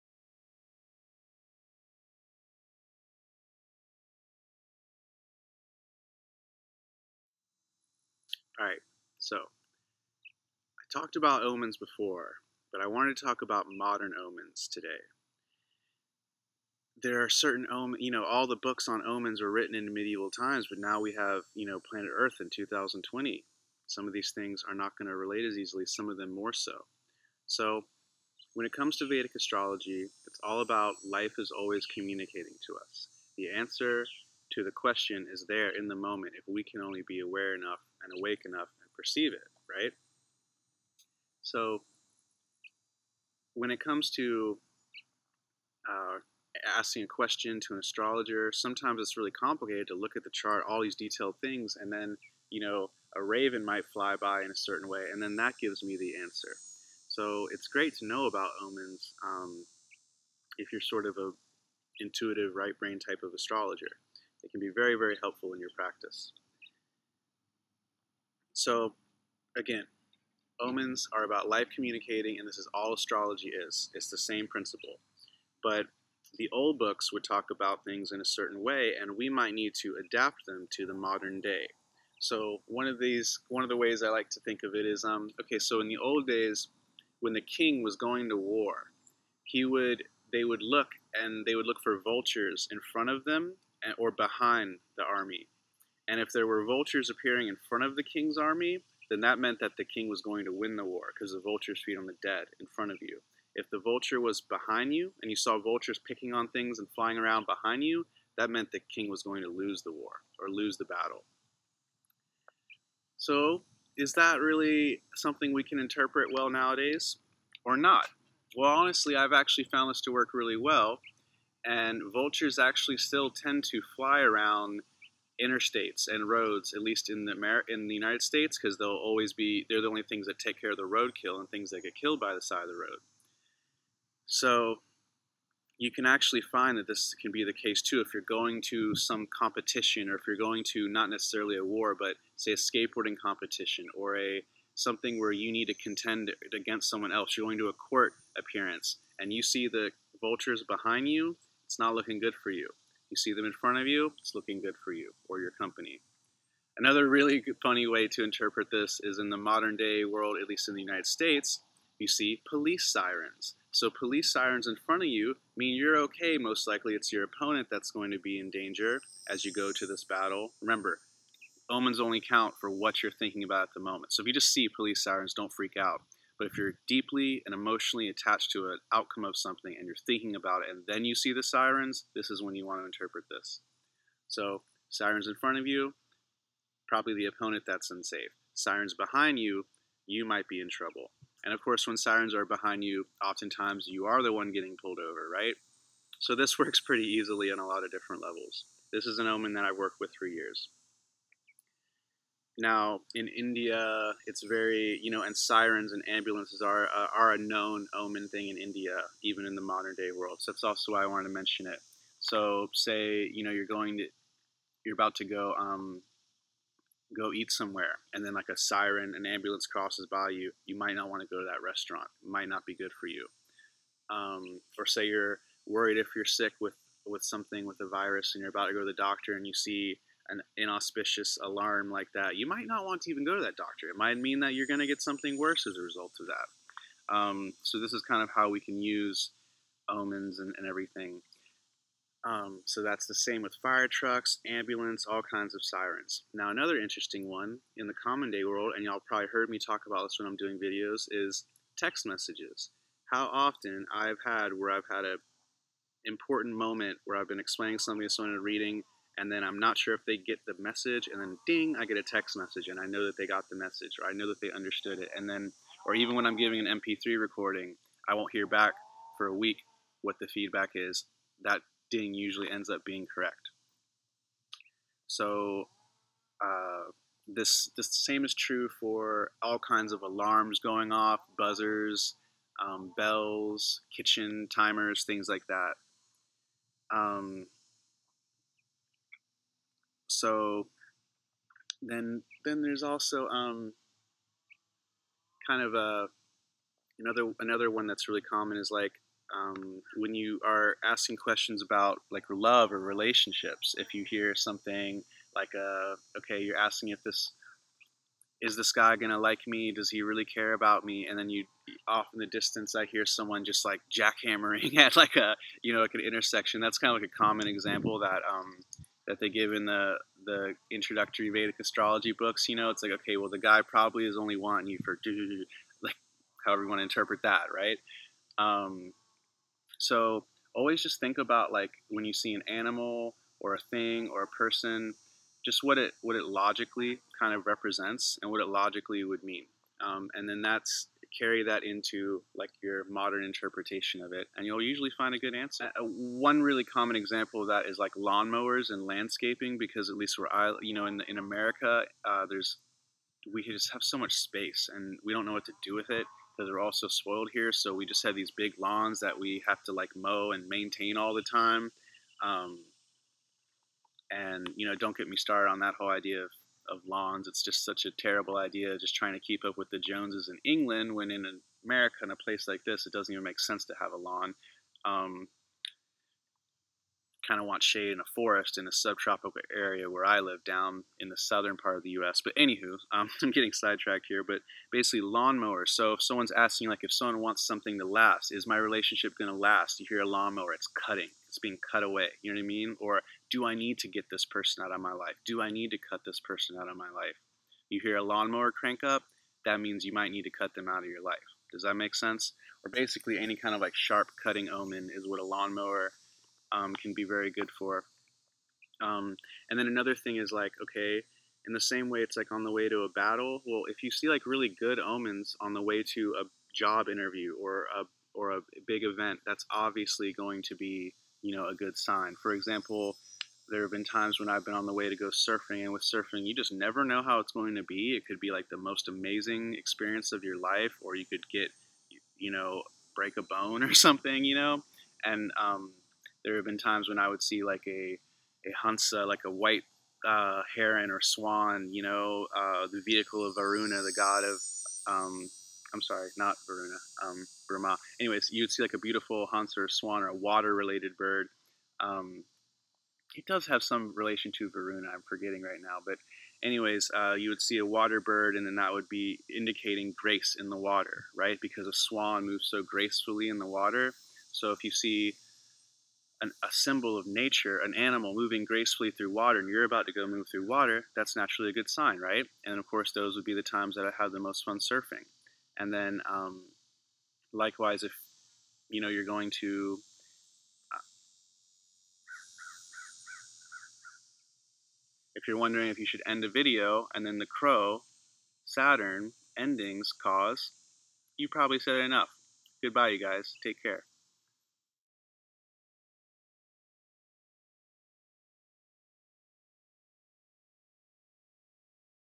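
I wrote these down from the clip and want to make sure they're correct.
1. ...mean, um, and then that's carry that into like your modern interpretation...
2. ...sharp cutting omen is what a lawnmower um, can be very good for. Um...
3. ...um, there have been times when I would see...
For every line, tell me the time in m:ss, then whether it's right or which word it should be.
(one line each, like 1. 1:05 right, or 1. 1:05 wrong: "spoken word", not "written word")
1. 5:39 right
2. 6:43 right
3. 7:15 right.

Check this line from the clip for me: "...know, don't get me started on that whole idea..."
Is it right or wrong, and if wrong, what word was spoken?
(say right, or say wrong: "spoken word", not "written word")
right.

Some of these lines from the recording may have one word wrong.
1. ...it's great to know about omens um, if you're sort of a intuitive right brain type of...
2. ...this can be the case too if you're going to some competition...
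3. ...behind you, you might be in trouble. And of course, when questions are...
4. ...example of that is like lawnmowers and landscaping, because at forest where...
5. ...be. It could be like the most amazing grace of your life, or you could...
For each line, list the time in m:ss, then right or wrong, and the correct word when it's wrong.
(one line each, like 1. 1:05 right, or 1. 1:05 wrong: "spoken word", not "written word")
1. 0:57 right
2. 2:16 right
3. 3:08 wrong: "sirens", not "questions"
4. 5:46 wrong: "least", not "forest"
5. 7:07 wrong: "experience", not "grace".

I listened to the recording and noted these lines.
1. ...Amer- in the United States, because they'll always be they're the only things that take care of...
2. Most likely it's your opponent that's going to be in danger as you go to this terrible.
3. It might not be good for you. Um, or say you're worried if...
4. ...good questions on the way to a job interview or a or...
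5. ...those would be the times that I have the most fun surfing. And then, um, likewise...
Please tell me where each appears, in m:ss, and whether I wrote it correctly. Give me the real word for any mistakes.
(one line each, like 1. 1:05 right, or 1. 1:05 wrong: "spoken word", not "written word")
1. 2:07 right
2. 2:46 wrong: "battle", not "terrible"
3. 3:42 right
4. 6:54 wrong: "omens", not "questions"
5. 7:52 right.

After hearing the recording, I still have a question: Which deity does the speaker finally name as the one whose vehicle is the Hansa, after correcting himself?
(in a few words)
Brahma.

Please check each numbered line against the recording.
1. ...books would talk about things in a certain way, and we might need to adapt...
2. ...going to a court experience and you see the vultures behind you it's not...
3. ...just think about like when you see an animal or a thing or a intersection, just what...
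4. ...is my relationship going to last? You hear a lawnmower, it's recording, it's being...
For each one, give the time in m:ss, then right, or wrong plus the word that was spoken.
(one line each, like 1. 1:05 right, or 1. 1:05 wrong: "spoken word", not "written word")
1. 1:16 right
2. 2:27 wrong: "appearance", not "experience"
3. 5:30 wrong: "person", not "intersection"
4. 6:28 wrong: "cutting", not "recording".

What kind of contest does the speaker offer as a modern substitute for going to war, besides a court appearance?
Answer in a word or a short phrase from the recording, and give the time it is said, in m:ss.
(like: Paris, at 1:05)
Skateboarding competition, at 2:22.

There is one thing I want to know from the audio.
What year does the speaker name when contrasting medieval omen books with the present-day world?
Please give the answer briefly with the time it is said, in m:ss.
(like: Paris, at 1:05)
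2020, at 0:22.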